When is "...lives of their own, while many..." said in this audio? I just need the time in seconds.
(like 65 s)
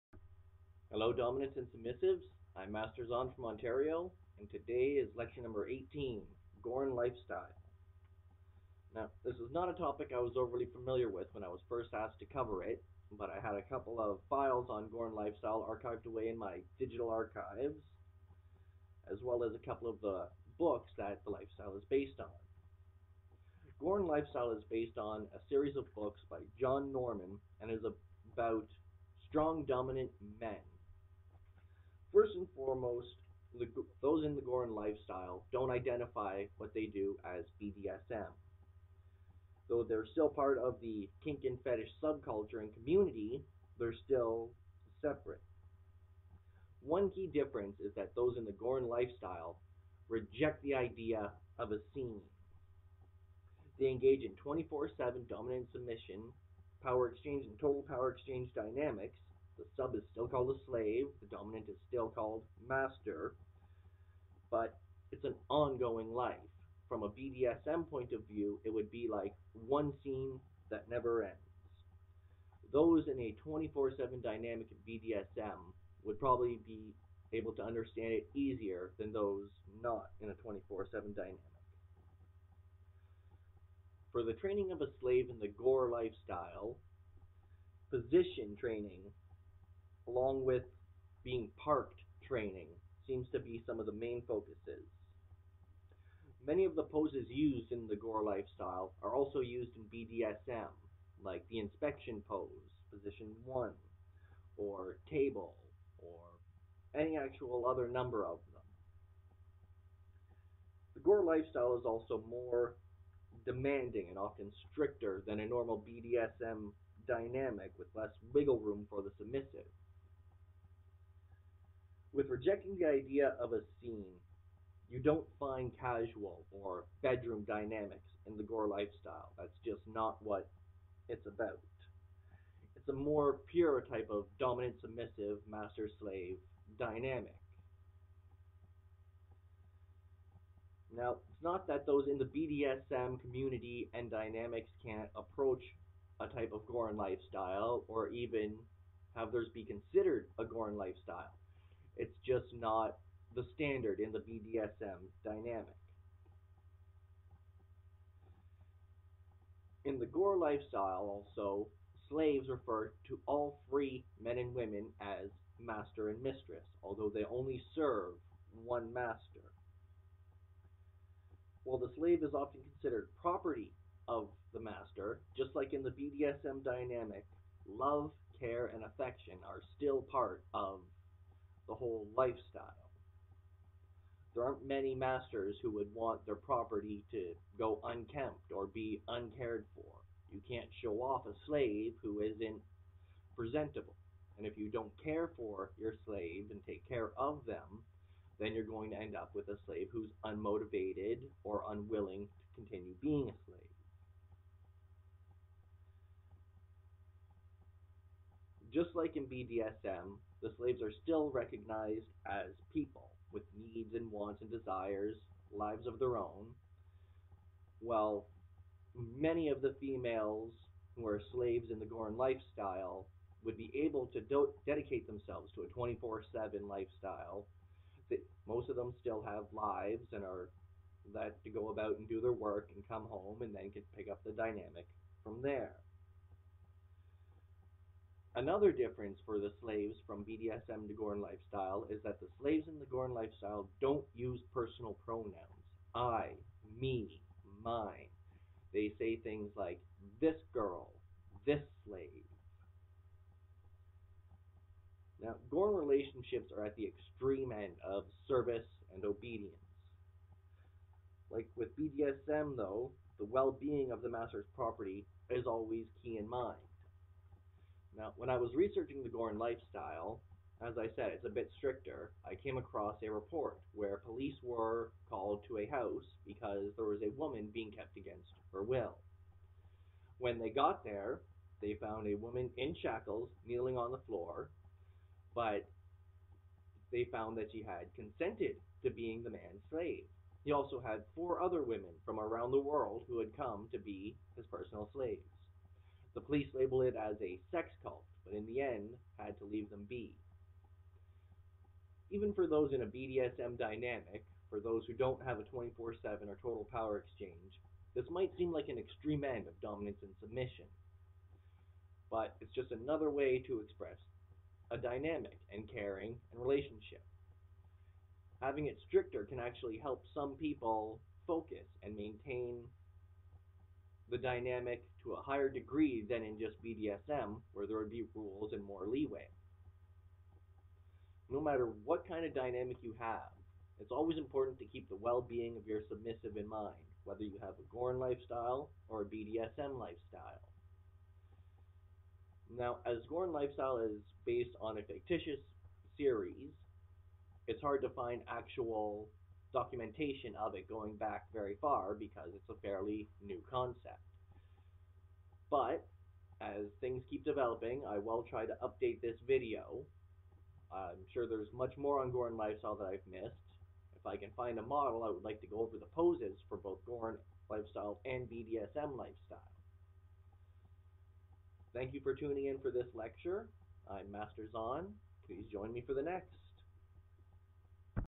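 215 s.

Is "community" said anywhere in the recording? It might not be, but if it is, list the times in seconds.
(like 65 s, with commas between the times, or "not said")
42 s, 143 s.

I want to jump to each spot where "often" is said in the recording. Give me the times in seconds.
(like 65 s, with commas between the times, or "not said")
114 s, 172 s.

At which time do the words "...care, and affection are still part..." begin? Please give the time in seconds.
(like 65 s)
178 s.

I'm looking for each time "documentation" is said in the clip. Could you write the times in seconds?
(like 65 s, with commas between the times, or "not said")
349 s.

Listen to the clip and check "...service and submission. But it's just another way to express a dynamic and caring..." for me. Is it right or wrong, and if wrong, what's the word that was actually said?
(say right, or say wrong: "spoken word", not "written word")
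wrong: "dominance", not "service".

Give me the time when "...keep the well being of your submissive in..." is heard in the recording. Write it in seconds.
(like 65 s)
334 s.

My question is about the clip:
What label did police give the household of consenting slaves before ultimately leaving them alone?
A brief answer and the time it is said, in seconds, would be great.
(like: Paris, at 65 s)
sex cult, at 297 s.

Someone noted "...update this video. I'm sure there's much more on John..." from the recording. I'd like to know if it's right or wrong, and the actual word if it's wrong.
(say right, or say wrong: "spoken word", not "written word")
wrong: "Gorean", not "John".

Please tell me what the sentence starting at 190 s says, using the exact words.
You can't show off a slave who isn't presentable.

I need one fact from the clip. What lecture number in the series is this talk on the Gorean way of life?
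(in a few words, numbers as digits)
18.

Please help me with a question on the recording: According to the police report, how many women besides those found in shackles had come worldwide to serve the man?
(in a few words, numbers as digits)
4.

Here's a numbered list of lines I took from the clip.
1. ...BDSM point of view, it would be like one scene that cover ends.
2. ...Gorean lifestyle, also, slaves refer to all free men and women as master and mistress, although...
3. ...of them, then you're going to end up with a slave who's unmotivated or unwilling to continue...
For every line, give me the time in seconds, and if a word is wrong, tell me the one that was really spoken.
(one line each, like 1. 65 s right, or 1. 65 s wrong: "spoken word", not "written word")
1. 67 s wrong: "never", not "cover"
2. 160 s right
3. 197 s right.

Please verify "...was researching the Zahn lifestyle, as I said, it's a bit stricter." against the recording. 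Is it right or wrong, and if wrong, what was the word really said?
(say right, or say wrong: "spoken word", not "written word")
wrong: "Gorean", not "Zahn".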